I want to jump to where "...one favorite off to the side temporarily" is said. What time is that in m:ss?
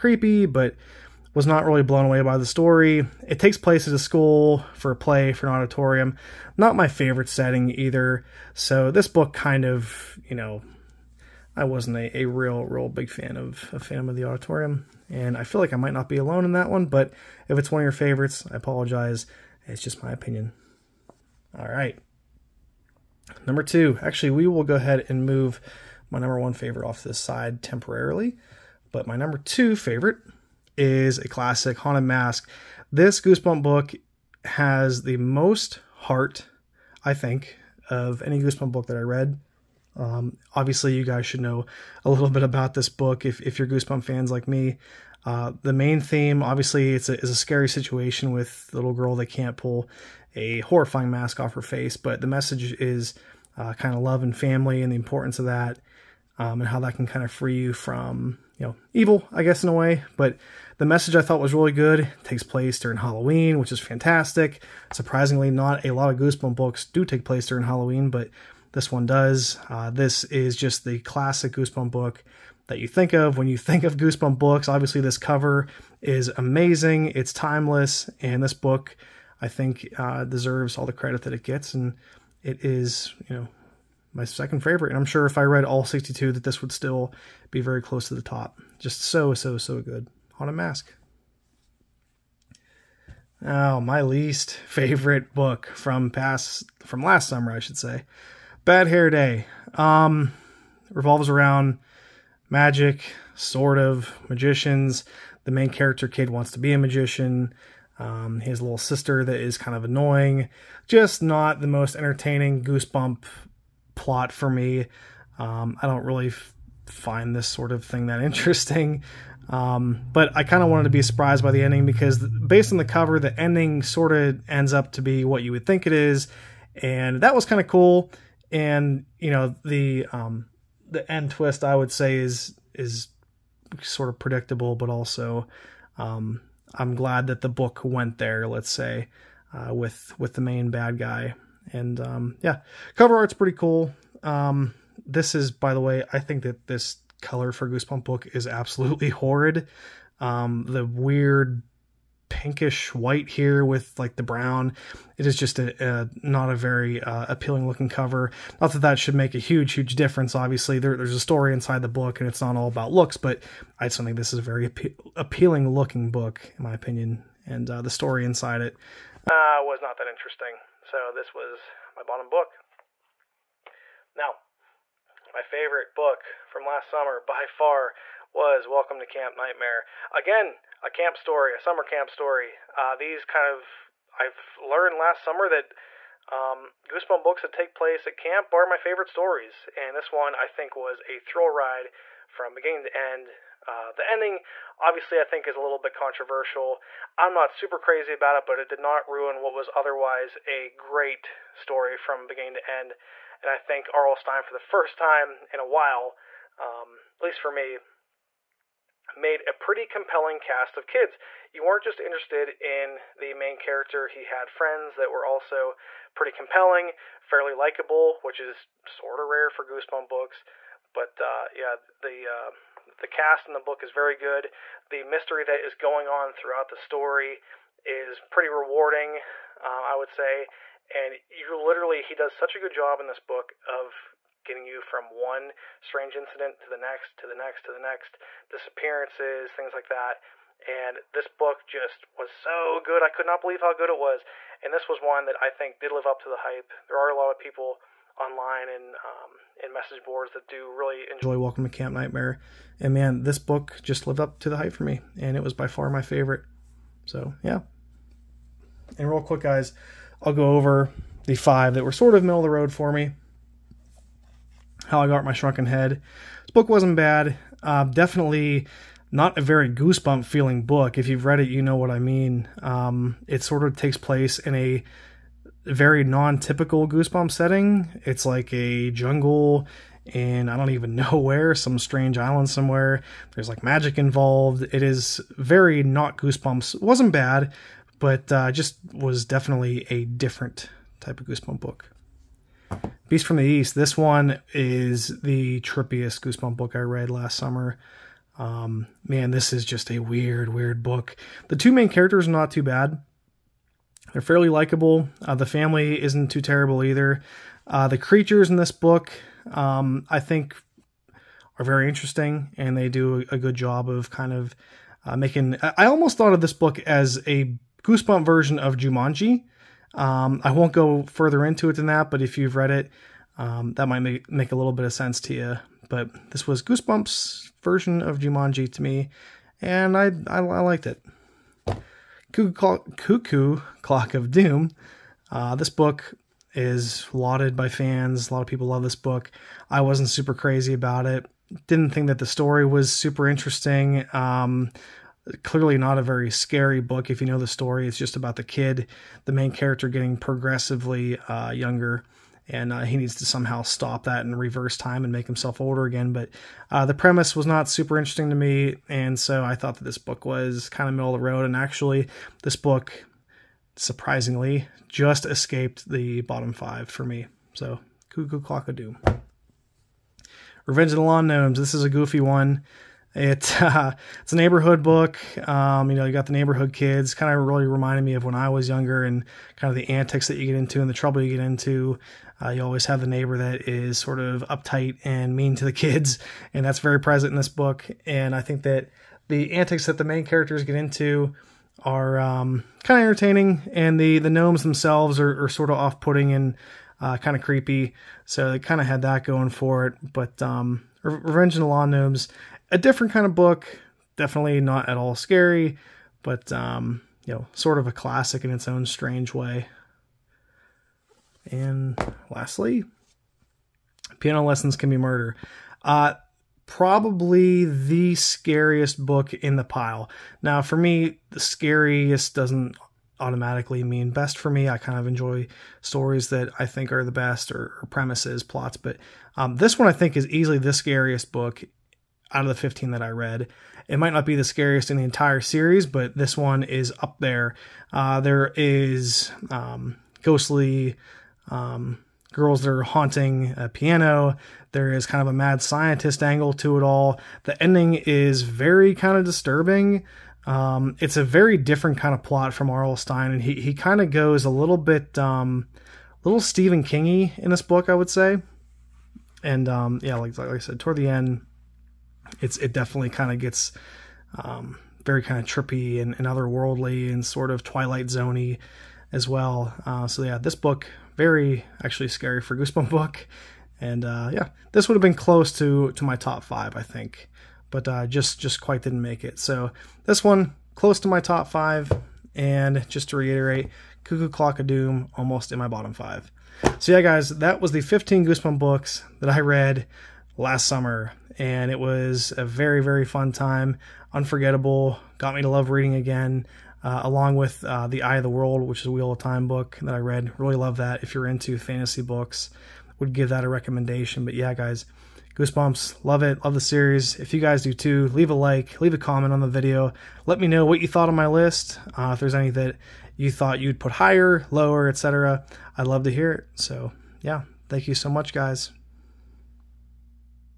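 0:26.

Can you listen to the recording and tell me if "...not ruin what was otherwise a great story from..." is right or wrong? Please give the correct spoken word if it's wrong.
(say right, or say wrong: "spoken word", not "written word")
right.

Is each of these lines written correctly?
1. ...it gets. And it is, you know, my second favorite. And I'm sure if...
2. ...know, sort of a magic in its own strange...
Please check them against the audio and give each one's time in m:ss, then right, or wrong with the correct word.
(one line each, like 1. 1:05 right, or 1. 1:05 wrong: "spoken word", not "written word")
1. 1:21 right
2. 6:47 wrong: "classic", not "magic".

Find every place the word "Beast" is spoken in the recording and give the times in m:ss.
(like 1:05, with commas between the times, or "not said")
4:53.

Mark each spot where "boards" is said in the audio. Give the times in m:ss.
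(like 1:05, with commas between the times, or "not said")
4:10.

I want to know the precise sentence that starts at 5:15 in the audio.
I almost thought of this book as a goosebump version of Jumanji.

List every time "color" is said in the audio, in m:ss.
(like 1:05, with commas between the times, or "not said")
2:27.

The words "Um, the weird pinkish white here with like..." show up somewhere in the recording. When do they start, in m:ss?
2:30.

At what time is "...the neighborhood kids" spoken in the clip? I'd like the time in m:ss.
6:16.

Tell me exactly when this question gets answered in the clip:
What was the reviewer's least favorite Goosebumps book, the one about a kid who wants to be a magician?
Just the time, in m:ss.
1:38.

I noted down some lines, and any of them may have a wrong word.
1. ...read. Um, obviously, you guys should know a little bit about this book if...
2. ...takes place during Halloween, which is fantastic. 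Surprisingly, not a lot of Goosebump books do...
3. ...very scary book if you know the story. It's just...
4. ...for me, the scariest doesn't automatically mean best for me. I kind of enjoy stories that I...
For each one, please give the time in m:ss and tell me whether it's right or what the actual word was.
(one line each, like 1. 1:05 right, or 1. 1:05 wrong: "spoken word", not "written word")
1. 0:39 right
2. 1:02 right
3. 5:46 right
4. 7:00 right.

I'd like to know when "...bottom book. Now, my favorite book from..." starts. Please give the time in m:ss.
2:52.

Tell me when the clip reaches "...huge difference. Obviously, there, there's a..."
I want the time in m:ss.
2:39.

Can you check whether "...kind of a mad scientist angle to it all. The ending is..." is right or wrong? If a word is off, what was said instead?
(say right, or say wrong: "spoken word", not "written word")
right.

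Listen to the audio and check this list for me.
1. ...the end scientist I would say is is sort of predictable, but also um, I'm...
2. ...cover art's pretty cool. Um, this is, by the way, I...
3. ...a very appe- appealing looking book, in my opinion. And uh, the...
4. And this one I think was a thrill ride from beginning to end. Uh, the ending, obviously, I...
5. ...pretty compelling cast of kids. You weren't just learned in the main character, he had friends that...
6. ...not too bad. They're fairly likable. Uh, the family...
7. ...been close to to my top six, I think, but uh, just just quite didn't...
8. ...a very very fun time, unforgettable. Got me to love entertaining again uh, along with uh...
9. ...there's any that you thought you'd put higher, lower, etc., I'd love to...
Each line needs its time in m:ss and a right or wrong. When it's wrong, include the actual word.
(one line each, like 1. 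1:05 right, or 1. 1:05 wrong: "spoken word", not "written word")
1. 2:10 wrong: "twist", not "scientist"
2. 2:22 right
3. 2:44 right
4. 3:09 right
5. 3:29 wrong: "interested", not "learned"
6. 5:02 right
7. 7:55 wrong: "five", not "six"
8. 8:12 wrong: "reading", not "entertaining"
9. 8:32 right.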